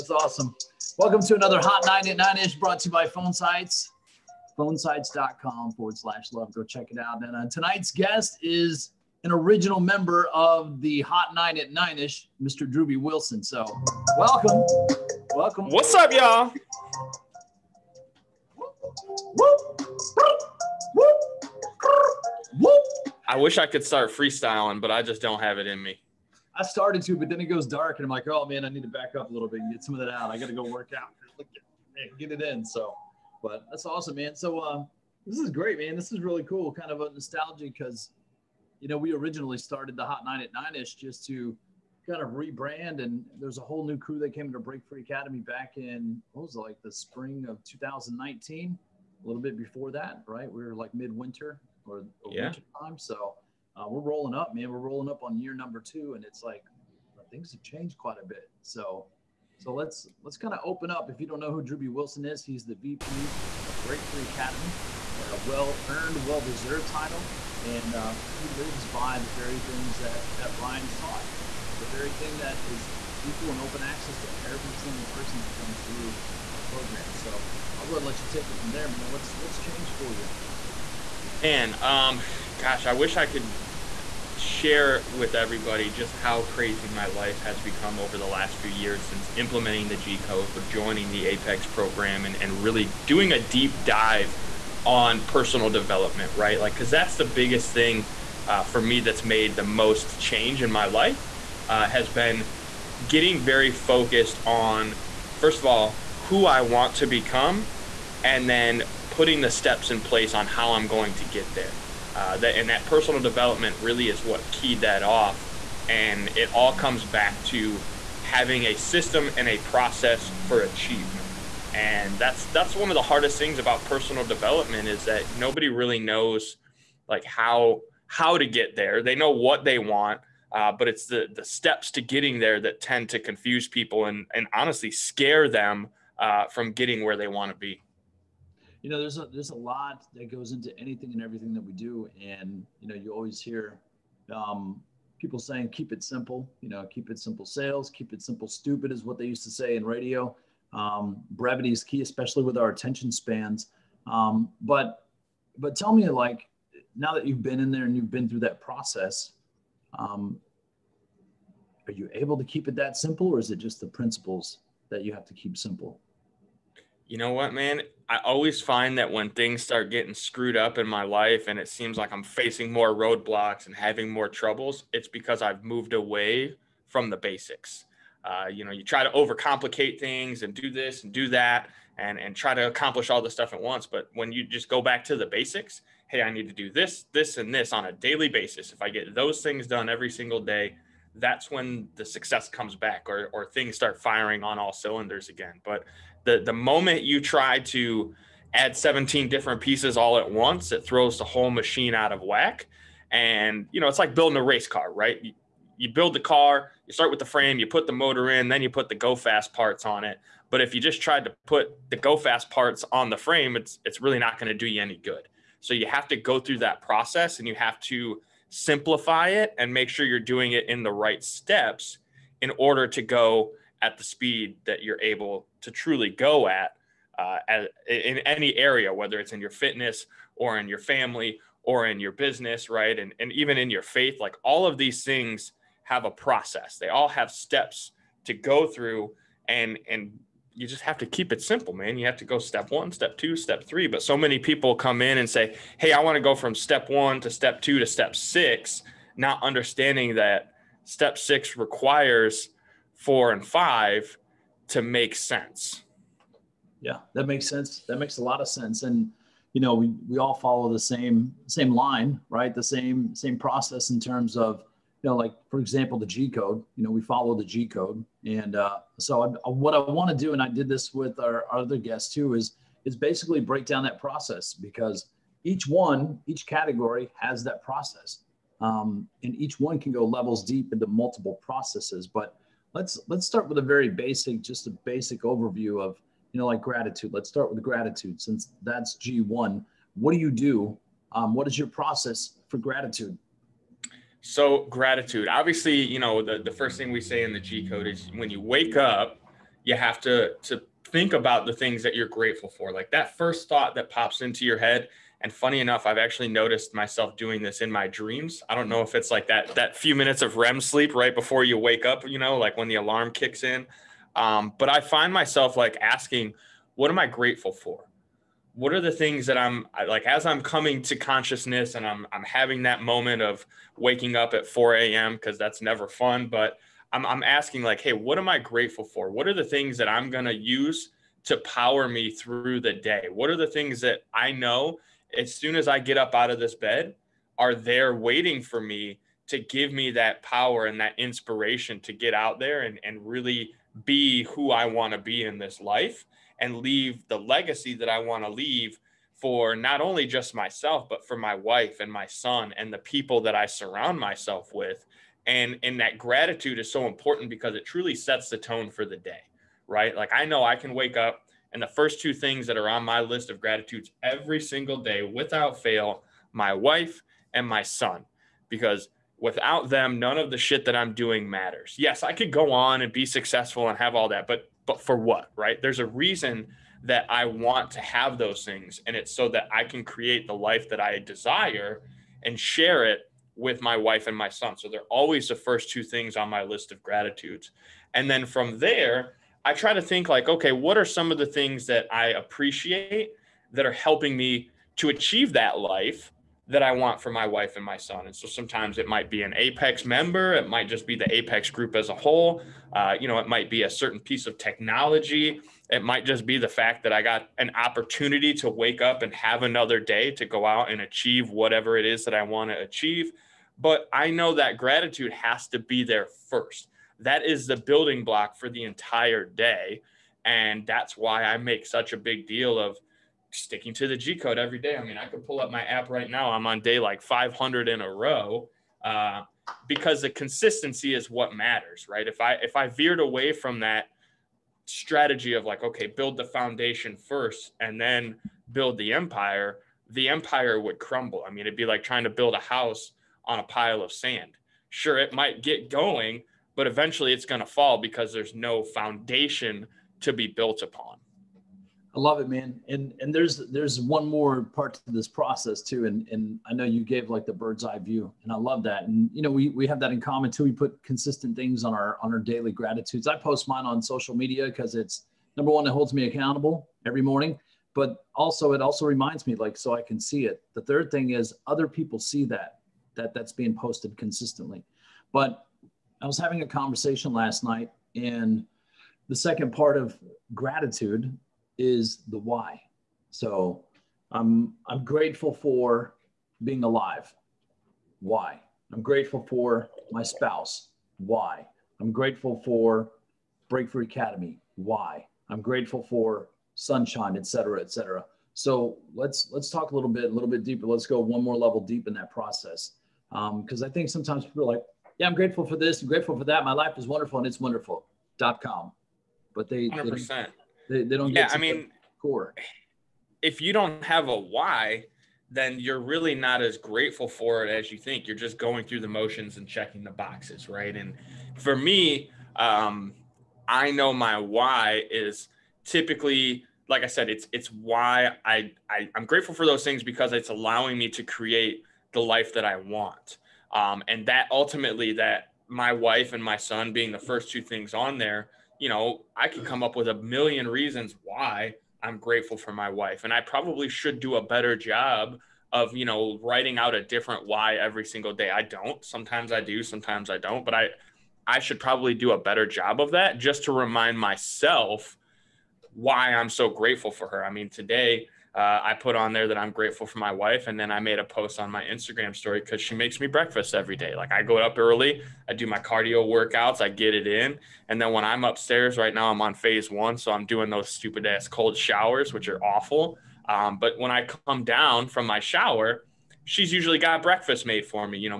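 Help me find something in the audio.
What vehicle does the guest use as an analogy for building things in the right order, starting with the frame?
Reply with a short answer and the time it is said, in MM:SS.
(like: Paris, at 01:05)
Race car, at 03:24.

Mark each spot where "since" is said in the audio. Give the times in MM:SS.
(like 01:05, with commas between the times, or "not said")
01:29, 04:48.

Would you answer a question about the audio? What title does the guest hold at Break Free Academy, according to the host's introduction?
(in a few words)
VP.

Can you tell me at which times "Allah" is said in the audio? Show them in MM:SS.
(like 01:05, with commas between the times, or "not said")
not said.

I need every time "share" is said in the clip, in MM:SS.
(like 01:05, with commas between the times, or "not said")
01:24, 06:22.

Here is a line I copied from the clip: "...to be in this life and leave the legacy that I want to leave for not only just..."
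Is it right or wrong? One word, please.
right.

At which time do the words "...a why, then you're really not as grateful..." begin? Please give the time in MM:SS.
08:34.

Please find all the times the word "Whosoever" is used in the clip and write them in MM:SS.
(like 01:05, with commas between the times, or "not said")
not said.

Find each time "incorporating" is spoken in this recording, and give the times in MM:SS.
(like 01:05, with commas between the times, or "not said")
not said.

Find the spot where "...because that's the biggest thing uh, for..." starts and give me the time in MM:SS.
01:36.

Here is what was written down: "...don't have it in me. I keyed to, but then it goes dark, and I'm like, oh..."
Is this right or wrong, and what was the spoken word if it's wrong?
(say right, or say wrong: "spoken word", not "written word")
wrong: "started", not "keyed".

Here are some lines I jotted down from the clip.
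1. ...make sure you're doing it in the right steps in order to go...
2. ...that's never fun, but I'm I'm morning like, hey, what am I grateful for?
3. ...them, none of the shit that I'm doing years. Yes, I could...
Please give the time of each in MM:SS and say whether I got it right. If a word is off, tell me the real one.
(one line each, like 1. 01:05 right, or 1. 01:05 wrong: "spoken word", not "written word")
1. 03:39 right
2. 05:25 wrong: "asking", not "morning"
3. 06:09 wrong: "matters", not "years".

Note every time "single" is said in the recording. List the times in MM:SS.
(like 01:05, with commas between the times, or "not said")
01:14, 03:10, 06:04, 09:07.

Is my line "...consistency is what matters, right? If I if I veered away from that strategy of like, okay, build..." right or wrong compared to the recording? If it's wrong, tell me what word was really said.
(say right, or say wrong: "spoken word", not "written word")
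right.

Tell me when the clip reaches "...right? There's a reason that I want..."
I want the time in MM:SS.
06:15.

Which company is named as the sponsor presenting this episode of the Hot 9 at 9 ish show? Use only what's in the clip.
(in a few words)
Phone Sites.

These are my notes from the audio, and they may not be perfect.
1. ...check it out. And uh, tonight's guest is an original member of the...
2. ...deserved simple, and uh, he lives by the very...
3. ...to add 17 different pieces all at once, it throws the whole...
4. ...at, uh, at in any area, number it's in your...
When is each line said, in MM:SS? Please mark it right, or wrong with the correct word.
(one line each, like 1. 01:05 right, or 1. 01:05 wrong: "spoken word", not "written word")
1. 00:06 right
2. 01:06 wrong: "title", not "simple"
3. 03:17 right
4. 03:46 wrong: "whether", not "number".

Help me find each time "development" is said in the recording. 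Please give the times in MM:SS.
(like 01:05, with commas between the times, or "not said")
01:35, 01:53, 02:04.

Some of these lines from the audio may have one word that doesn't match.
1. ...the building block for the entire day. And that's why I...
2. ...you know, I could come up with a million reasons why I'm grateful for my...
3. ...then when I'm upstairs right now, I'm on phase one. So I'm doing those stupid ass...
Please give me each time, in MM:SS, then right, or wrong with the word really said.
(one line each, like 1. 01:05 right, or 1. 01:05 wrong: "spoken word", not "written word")
1. 06:57 right
2. 08:58 right
3. 09:27 right.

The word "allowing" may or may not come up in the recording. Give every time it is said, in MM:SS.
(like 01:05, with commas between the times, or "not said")
08:50.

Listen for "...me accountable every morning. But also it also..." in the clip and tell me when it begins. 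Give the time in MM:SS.
07:45.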